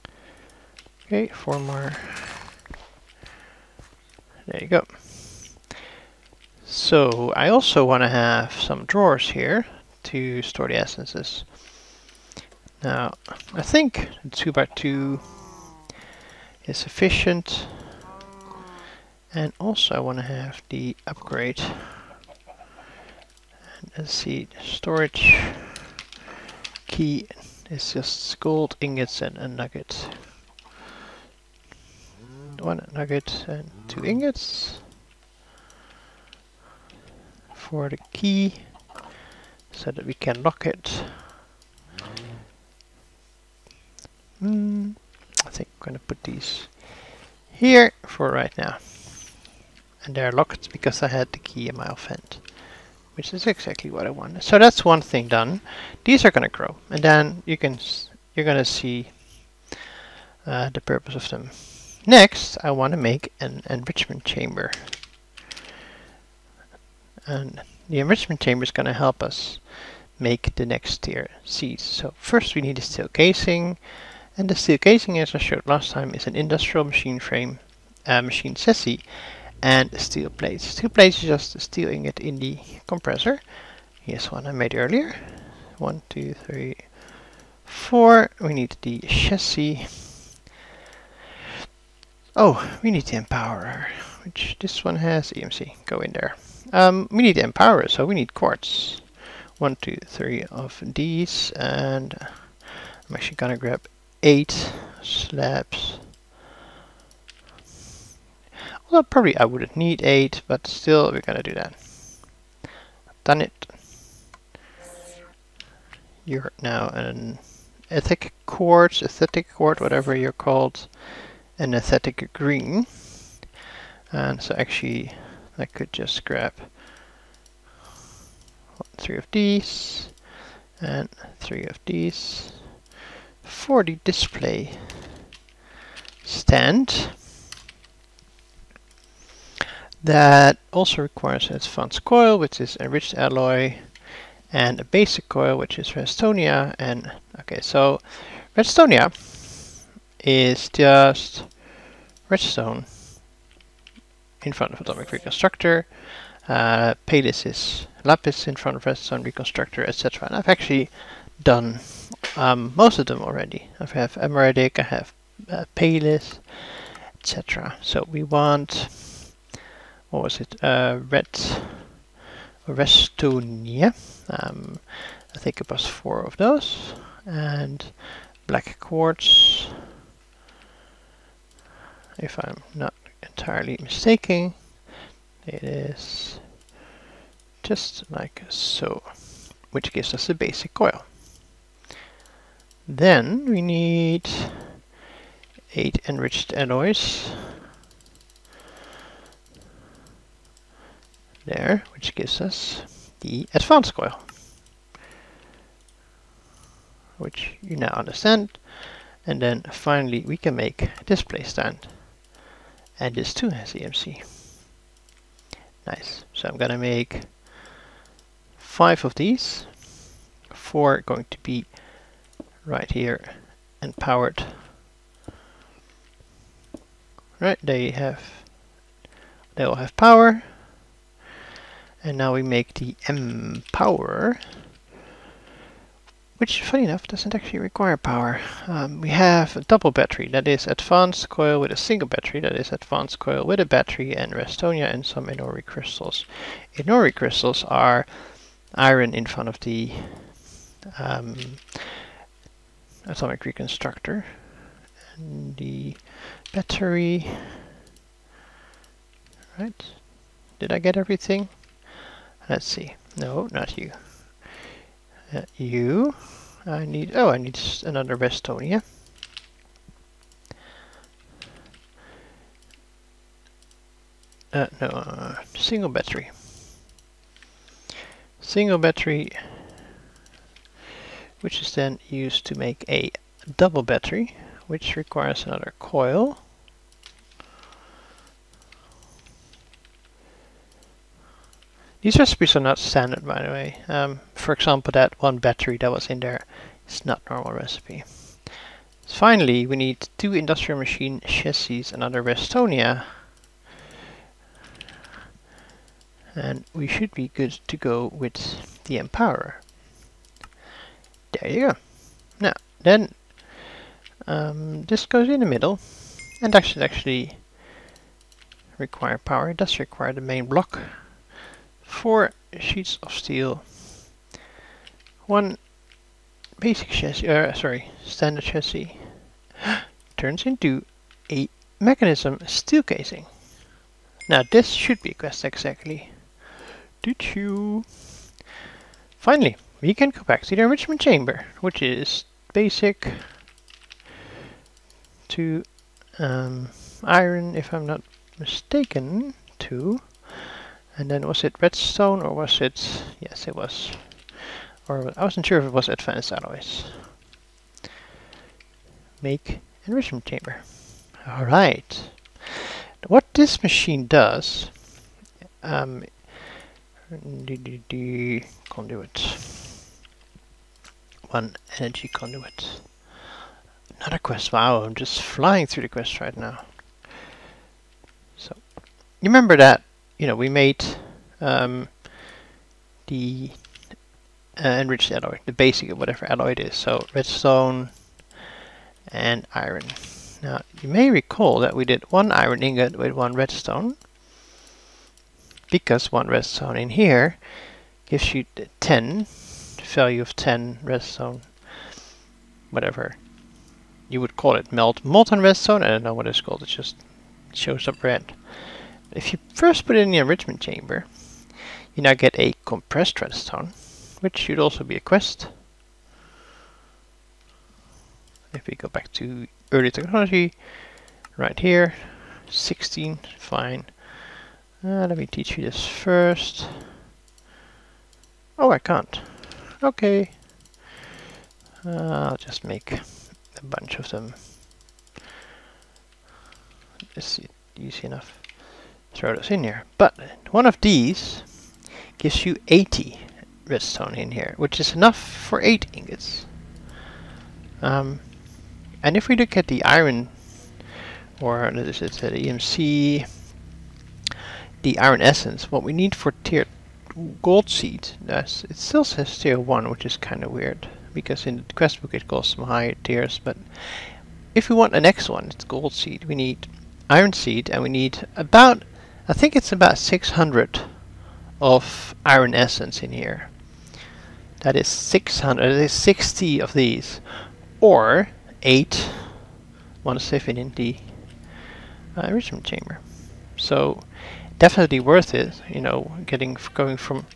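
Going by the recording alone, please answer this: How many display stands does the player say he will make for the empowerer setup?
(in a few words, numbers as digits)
5.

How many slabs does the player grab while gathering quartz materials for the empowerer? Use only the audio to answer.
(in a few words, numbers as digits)
8.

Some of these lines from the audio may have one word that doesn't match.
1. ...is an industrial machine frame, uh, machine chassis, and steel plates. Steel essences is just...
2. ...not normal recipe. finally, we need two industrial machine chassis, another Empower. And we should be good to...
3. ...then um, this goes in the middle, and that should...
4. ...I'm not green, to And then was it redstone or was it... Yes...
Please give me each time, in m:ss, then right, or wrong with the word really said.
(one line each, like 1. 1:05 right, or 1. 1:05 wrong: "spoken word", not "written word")
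1. 1:16 wrong: "plates", not "essences"
2. 4:57 wrong: "Restonia", not "Empower"
3. 5:12 right
4. 5:47 wrong: "mistaken", not "green".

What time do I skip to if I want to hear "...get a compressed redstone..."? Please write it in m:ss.
6:52.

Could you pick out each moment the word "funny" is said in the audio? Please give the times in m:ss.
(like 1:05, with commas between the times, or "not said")
3:56.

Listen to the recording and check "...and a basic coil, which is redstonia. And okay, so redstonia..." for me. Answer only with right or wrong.
right.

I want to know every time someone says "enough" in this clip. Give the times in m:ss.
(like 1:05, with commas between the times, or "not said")
3:56, 7:18, 7:24.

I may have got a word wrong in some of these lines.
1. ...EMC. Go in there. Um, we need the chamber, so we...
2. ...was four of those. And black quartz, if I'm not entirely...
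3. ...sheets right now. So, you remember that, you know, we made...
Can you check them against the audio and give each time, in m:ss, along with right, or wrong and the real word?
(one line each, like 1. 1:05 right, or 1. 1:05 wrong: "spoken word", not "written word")
1. 1:35 wrong: "empowerer", not "chamber"
2. 2:55 right
3. 6:15 wrong: "quests", not "sheets".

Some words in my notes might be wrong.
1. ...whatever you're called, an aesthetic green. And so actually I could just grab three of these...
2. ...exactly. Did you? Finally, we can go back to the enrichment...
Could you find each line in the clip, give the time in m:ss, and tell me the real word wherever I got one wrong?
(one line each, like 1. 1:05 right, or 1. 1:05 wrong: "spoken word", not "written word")
1. 1:59 right
2. 5:35 right.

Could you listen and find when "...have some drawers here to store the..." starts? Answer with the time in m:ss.
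0:08.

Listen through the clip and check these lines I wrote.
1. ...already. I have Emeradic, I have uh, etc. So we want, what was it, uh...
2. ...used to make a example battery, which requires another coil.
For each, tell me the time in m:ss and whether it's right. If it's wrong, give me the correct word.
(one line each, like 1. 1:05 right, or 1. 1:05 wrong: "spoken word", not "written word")
1. 2:43 right
2. 4:42 wrong: "double", not "example".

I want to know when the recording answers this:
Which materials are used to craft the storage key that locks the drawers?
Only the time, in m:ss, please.
0:28.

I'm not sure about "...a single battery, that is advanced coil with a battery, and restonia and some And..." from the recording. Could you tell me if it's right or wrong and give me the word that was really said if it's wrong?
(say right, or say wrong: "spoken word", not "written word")
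wrong: "Enori", not "And".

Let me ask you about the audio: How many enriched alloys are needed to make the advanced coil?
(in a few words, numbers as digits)
8.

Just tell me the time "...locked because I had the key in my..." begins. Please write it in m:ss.
0:50.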